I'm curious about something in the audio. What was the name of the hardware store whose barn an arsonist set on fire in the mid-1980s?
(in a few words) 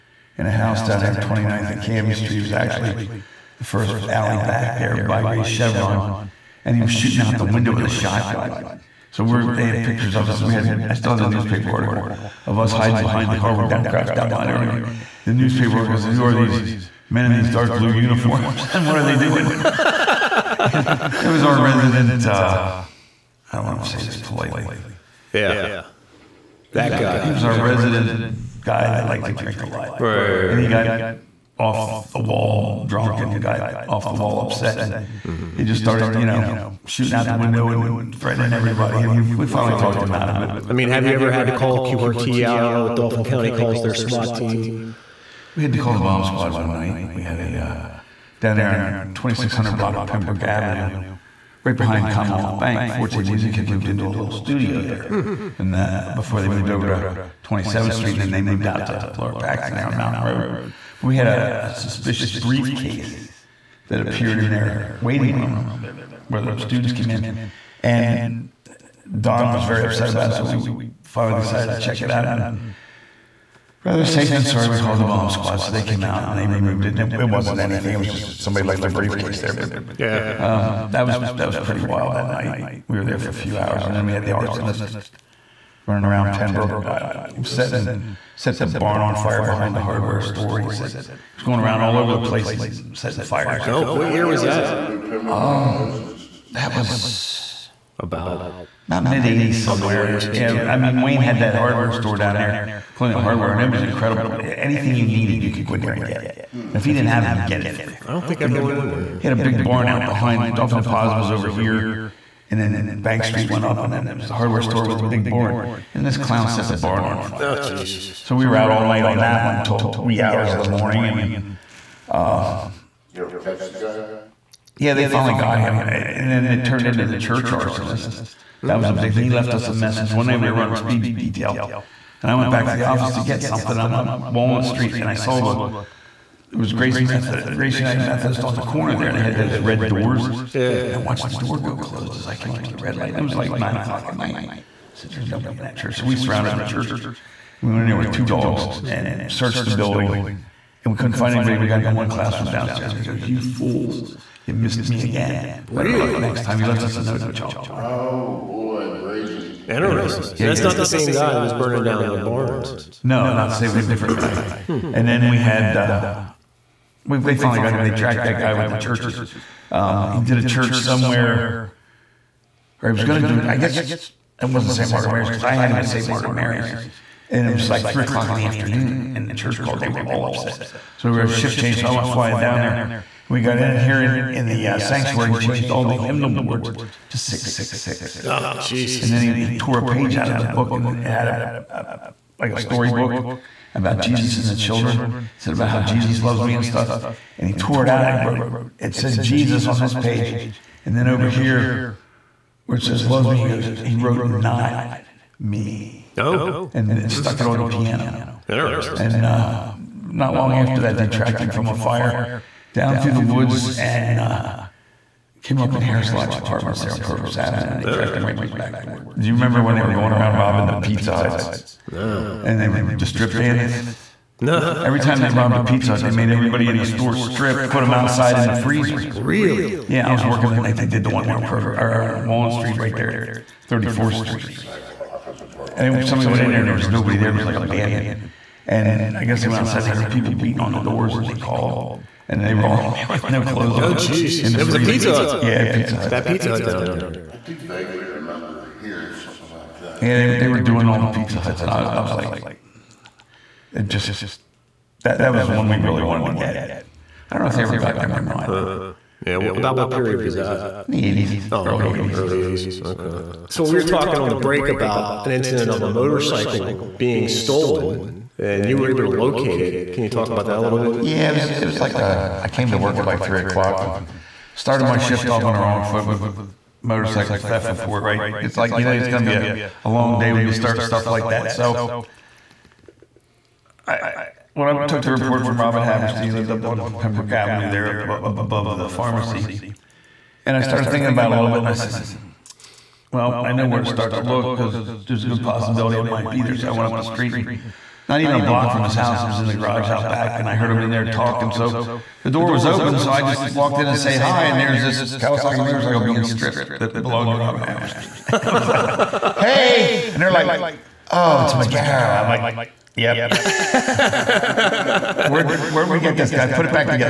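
Colonial Hardware.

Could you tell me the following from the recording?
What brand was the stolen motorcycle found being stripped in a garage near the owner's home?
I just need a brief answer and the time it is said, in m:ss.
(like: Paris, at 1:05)
Kawasaki, at 5:05.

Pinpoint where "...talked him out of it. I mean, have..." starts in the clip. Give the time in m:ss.
0:39.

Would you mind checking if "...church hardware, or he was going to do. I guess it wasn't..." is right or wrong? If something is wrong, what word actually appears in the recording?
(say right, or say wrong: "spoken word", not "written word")
wrong: "somewhere", not "hardware".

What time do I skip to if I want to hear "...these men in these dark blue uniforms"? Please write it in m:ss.
0:16.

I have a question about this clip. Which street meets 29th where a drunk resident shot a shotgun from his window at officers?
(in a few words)
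Canby Street.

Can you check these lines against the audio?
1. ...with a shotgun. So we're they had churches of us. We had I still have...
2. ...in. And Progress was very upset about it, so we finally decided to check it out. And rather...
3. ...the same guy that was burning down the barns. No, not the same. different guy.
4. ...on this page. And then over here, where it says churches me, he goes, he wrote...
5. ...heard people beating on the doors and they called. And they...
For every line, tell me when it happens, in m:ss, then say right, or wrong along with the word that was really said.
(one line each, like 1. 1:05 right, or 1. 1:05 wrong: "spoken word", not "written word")
1. 0:07 wrong: "pictures", not "churches"
2. 1:07 wrong: "Don", not "Progress"
3. 2:40 right
4. 3:19 wrong: "loves", not "churches"
5. 3:59 right.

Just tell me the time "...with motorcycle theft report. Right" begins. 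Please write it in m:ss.
4:36.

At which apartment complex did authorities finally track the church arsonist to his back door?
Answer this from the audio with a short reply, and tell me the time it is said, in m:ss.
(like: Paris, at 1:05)
Harris Lodge Apartments, at 3:35.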